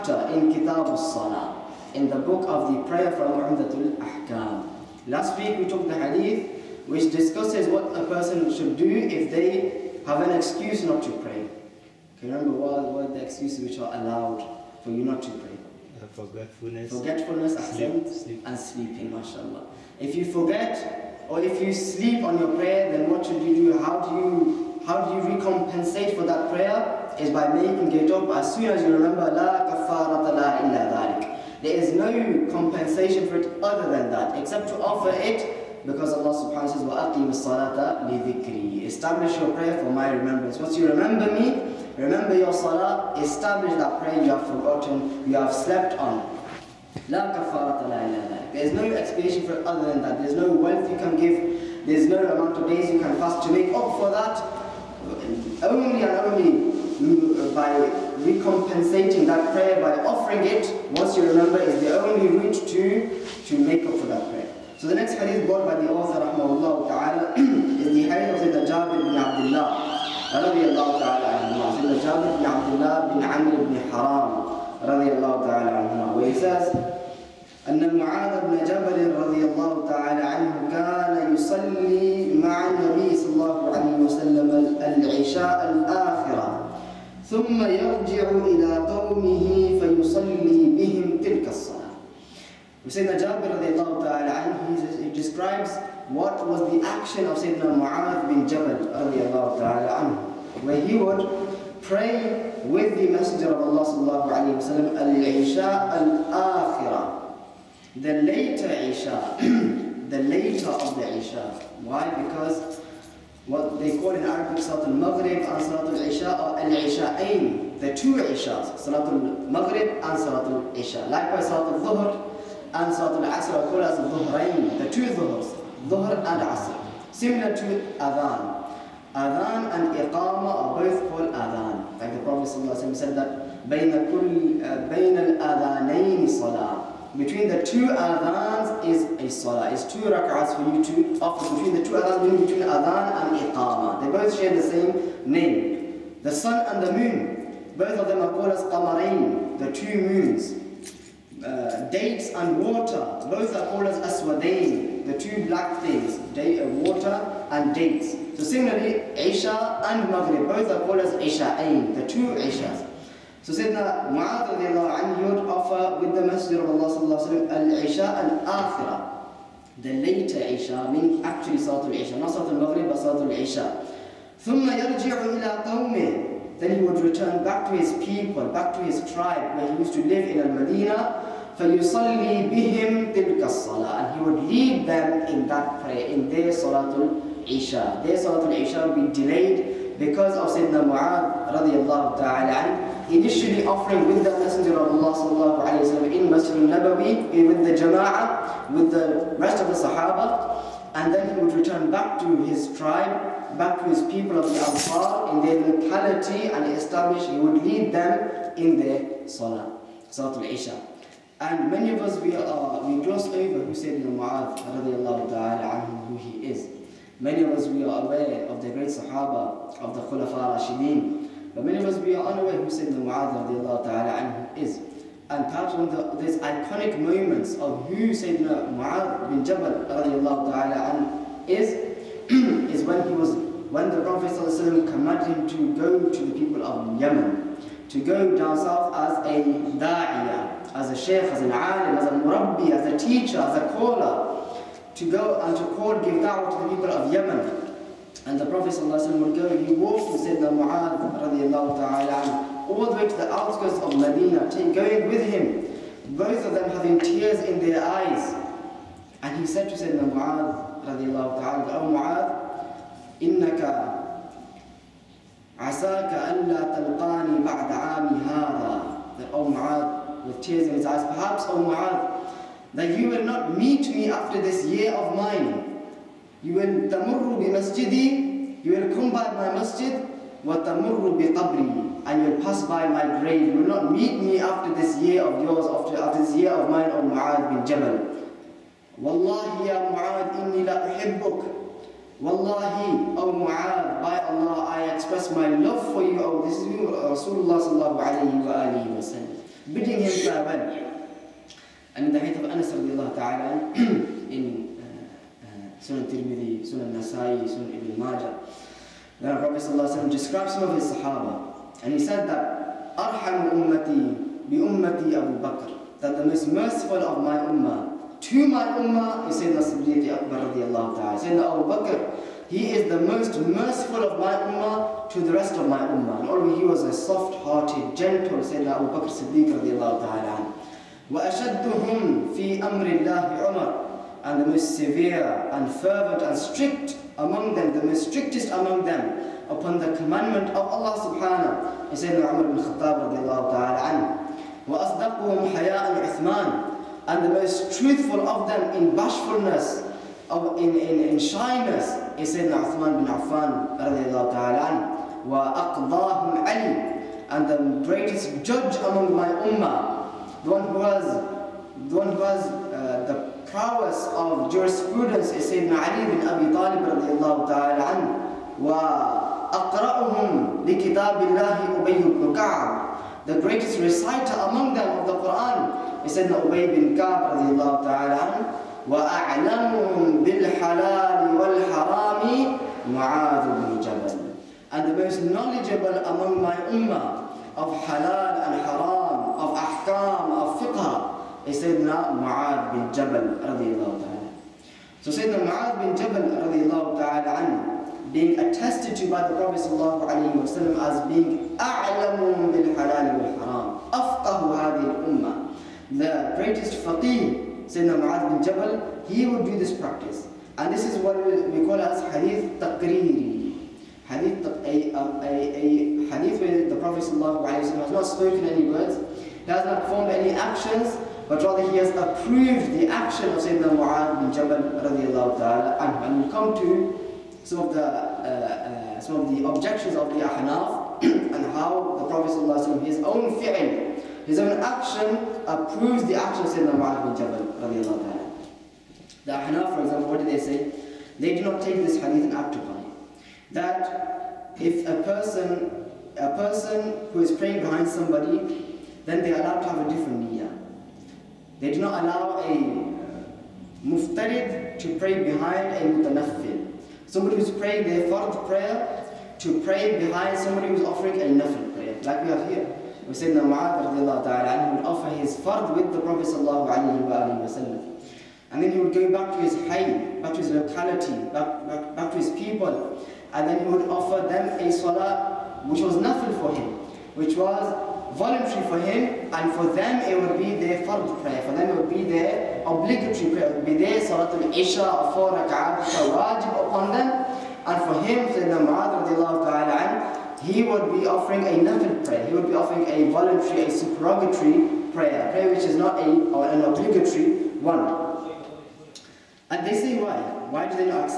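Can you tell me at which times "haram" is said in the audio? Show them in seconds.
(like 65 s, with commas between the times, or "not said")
73 s, 388 s.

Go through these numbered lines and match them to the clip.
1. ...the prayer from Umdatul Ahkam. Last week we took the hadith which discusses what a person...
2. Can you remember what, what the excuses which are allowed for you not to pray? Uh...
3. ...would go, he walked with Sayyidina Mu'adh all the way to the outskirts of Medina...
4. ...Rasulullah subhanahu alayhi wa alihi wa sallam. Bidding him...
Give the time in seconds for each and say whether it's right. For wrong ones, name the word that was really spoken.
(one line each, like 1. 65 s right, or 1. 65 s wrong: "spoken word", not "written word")
1. 2 s right
2. 12 s right
3. 249 s right
4. 296 s wrong: "sallallahu", not "subhanahu".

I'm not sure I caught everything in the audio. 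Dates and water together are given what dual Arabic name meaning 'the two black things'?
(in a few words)
aswadain.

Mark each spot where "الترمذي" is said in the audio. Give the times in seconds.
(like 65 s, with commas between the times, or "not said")
305 s.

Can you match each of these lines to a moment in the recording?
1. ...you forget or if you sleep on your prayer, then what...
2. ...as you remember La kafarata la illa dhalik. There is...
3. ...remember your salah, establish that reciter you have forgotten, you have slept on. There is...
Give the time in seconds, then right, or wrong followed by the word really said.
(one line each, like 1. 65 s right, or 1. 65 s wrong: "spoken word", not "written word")
1. 20 s right
2. 28 s right
3. 41 s wrong: "prayer", not "reciter".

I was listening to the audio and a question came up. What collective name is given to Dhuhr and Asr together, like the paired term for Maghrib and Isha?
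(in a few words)
Dhuhrain.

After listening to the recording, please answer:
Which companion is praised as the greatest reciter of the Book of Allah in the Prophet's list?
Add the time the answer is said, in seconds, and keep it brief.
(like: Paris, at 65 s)
Ubay bin Ka'b, at 376 s.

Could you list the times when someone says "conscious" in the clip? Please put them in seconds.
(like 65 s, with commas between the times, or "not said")
not said.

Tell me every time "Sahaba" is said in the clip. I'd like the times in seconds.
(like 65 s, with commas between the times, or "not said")
199 s, 218 s, 310 s.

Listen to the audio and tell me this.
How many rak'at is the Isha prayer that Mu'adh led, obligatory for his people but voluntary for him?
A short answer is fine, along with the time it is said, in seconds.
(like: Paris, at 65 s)
4, at 485 s.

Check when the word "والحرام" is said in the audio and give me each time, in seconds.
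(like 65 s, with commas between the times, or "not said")
381 s, 403 s.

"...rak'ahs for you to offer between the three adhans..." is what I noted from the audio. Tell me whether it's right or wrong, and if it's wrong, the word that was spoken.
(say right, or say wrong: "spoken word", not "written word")
wrong: "two", not "three".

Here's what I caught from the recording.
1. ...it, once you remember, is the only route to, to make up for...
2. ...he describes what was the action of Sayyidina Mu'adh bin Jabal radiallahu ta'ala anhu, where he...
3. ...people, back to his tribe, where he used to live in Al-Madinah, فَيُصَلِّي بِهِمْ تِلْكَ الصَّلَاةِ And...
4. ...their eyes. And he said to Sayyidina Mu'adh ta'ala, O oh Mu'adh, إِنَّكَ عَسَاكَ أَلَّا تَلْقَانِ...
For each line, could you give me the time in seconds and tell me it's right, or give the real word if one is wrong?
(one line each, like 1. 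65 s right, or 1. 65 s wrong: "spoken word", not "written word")
1. 60 s right
2. 94 s right
3. 178 s right
4. 257 s right.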